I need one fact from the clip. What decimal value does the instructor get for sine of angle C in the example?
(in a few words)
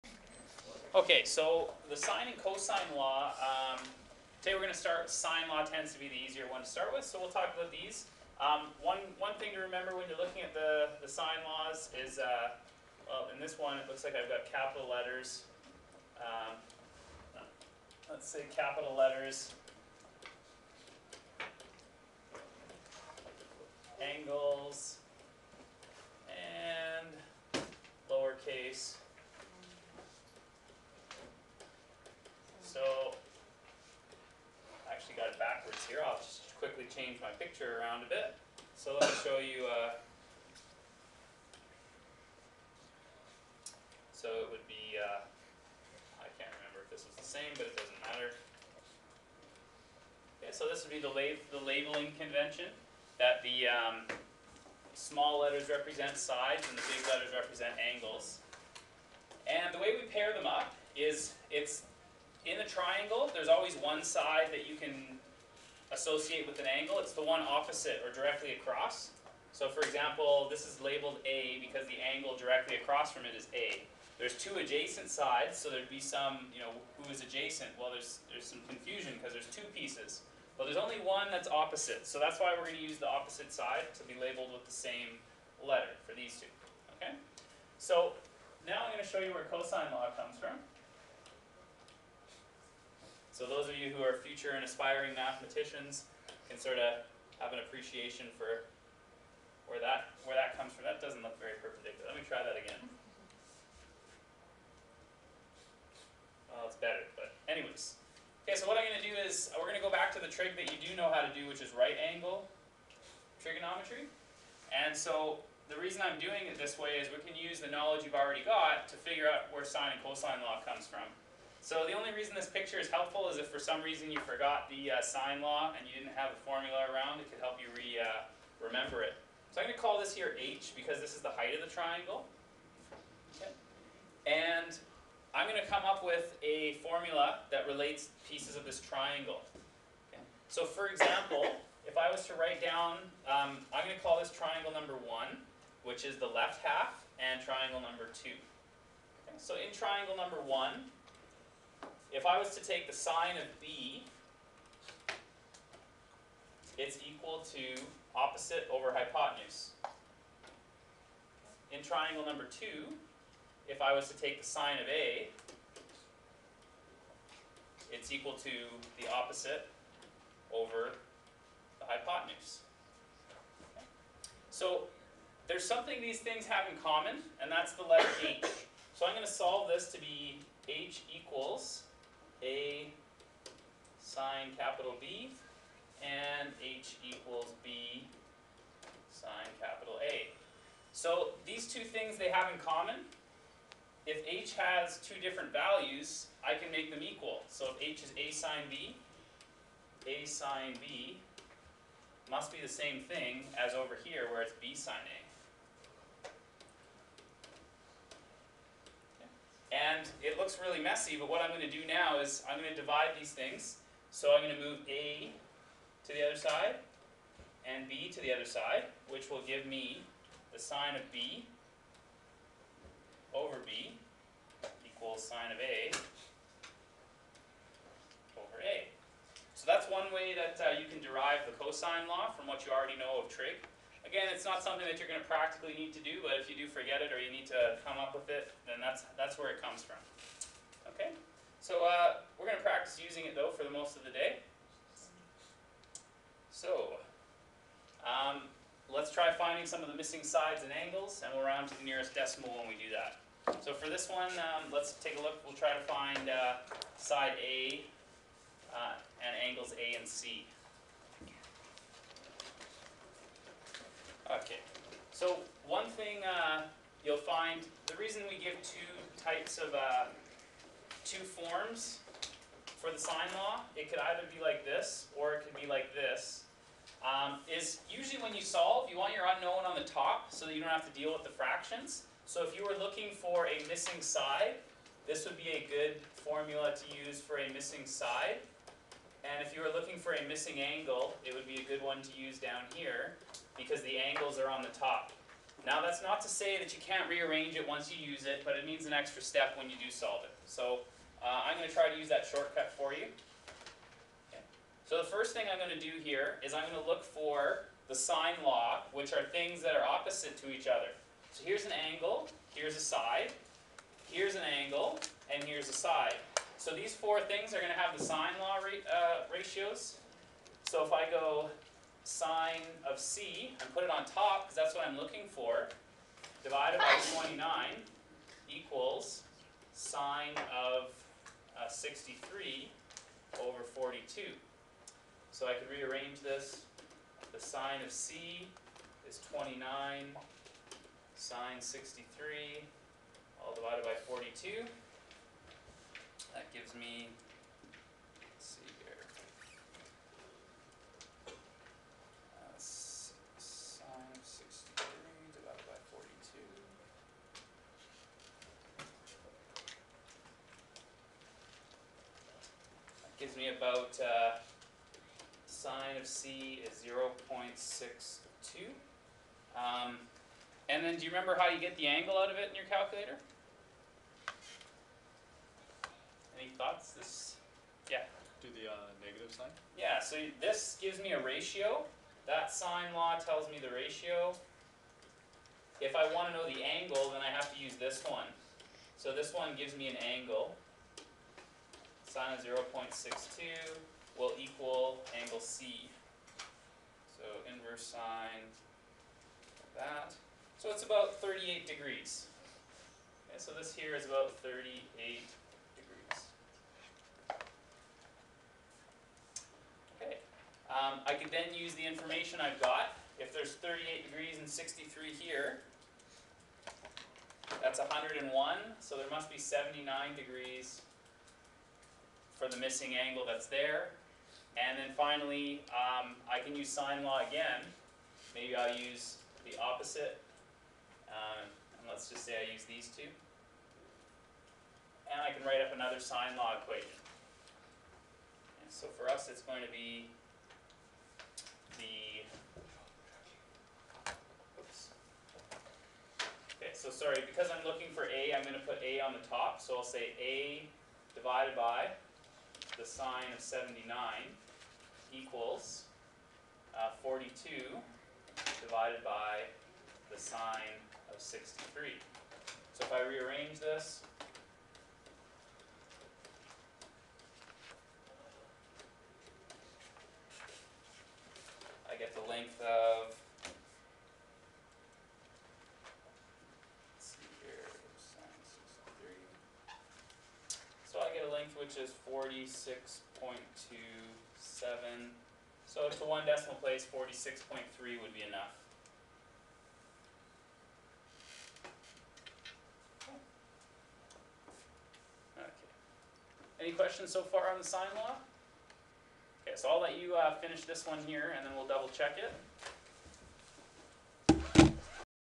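0.62.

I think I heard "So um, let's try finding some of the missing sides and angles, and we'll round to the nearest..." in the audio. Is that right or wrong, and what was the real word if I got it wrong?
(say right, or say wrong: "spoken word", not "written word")
right.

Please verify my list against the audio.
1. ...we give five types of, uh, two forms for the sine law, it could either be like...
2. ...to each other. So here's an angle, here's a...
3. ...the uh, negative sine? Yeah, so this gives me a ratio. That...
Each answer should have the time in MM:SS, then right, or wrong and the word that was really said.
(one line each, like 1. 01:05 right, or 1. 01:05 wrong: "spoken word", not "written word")
1. 04:28 wrong: "two", not "five"
2. 05:10 right
3. 06:18 right.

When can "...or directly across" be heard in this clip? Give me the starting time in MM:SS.
01:08.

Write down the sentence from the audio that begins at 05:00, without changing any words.
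So uh, I'm going to try to use that shortcut for you.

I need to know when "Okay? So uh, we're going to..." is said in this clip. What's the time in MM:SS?
04:00.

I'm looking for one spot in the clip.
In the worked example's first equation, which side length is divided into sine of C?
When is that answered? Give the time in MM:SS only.
05:26.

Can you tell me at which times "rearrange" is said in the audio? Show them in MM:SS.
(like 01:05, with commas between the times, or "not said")
04:57, 05:35, 07:43.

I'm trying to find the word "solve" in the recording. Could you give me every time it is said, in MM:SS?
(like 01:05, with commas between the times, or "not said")
02:59, 04:38, 04:59.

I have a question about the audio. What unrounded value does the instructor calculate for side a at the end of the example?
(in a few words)
46.27.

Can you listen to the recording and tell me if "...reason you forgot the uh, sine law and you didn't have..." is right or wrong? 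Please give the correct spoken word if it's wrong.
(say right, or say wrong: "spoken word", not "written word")
right.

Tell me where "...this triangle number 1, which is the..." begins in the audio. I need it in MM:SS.
02:24.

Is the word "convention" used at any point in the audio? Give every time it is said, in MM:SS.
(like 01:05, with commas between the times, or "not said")
00:52.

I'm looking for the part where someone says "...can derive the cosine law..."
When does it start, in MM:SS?
03:50.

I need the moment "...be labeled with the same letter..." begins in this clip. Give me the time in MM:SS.
01:24.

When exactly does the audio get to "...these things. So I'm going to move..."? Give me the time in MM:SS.
03:33.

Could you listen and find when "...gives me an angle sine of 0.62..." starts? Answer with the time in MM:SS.
06:29.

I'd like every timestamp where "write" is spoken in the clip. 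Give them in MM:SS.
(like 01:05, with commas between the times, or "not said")
02:22, 07:15.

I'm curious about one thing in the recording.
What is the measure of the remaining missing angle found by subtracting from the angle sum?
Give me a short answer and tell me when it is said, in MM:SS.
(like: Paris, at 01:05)
79 degrees, at 06:59.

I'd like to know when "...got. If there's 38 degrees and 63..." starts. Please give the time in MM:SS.
06:52.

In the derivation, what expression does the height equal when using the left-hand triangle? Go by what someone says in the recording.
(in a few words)
a sine B.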